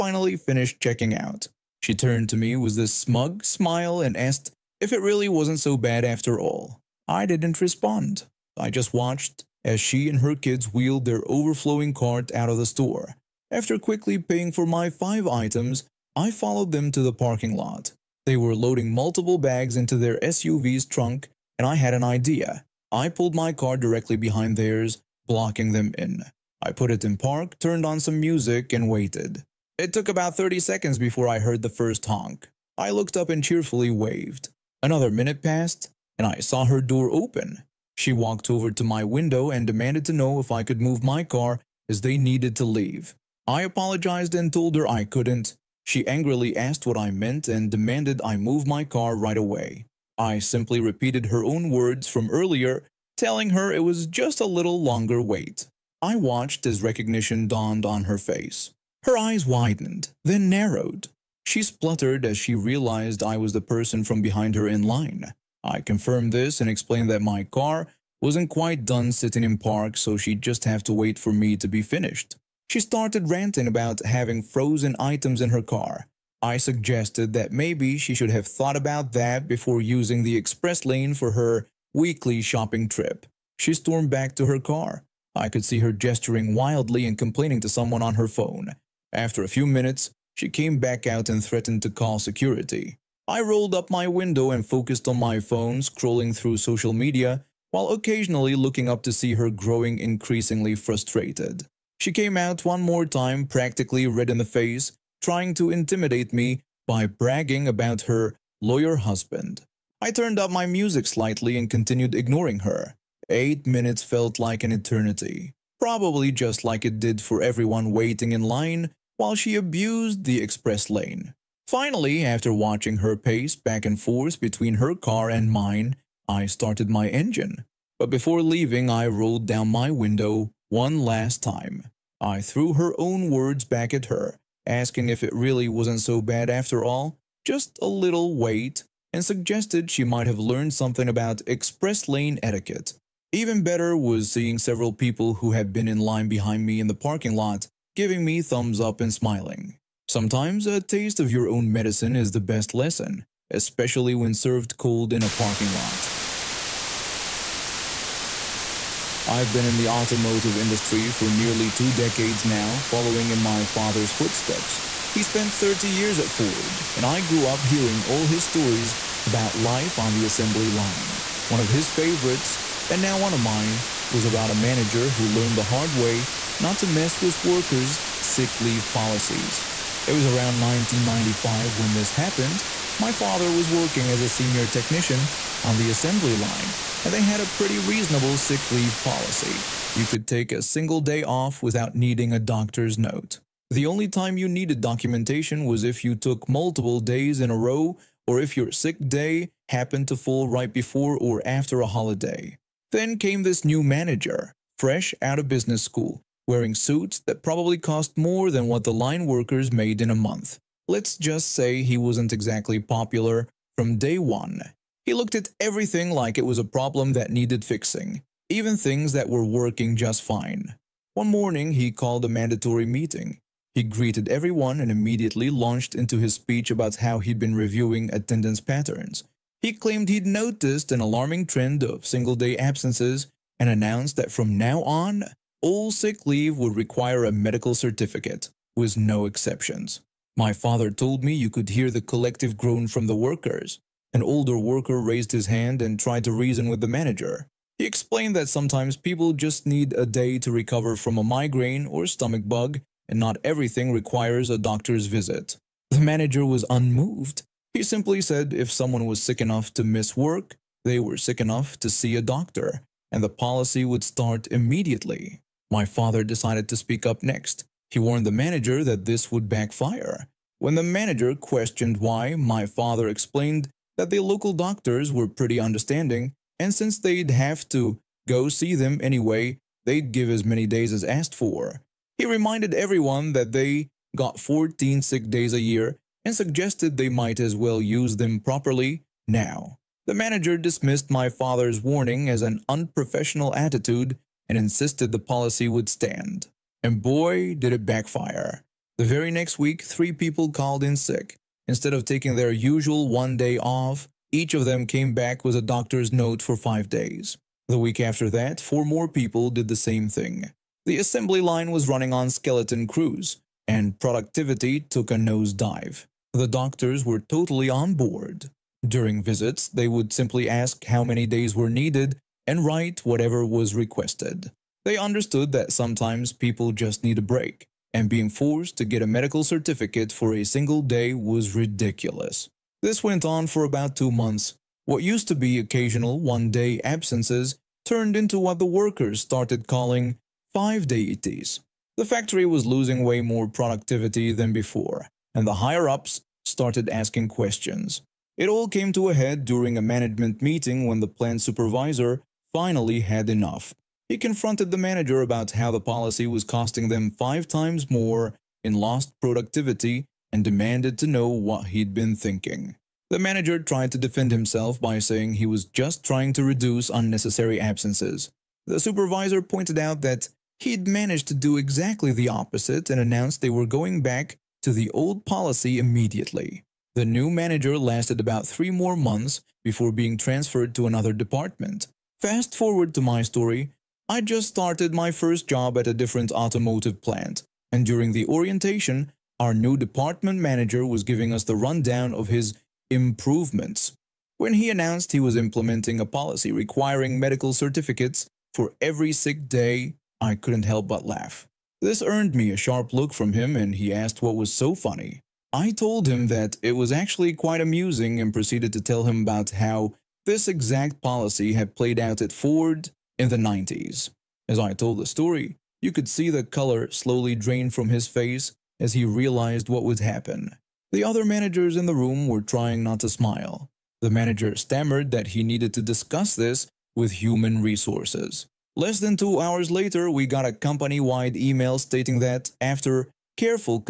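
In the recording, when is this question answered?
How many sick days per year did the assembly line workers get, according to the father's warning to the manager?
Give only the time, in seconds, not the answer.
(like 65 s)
284 s.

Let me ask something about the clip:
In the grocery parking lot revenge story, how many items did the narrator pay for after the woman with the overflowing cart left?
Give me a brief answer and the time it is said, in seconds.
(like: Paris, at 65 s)
5, at 14 s.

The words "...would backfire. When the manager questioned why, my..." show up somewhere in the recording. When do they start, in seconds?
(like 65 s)
269 s.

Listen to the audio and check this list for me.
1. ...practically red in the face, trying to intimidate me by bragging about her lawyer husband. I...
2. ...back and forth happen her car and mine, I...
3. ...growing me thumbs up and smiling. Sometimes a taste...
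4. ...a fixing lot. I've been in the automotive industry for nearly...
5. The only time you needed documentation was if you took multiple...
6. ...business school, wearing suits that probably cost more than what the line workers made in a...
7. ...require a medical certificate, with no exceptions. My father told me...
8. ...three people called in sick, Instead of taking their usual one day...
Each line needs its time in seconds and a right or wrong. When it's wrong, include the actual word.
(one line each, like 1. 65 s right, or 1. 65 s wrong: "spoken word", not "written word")
1. 103 s right
2. 123 s wrong: "between", not "happen"
3. 147 s wrong: "giving", not "growing"
4. 155 s wrong: "parking", not "fixing"
5. 193 s right
6. 205 s right
7. 236 s right
8. 299 s right.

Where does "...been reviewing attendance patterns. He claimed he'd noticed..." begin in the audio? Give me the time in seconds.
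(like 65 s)
227 s.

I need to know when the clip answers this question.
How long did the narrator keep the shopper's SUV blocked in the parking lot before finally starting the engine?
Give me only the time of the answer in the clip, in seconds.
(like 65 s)
113 s.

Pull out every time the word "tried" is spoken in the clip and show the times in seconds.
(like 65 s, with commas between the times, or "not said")
245 s, 363 s.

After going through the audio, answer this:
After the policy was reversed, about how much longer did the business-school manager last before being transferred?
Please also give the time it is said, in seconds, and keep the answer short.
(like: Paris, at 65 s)
3 months, at 378 s.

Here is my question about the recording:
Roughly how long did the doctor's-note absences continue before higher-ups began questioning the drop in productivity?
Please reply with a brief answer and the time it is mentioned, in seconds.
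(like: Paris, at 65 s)
2 months, at 333 s.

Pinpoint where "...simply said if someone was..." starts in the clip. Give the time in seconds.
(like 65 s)
257 s.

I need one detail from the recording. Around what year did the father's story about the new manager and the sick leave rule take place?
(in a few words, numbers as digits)
1995.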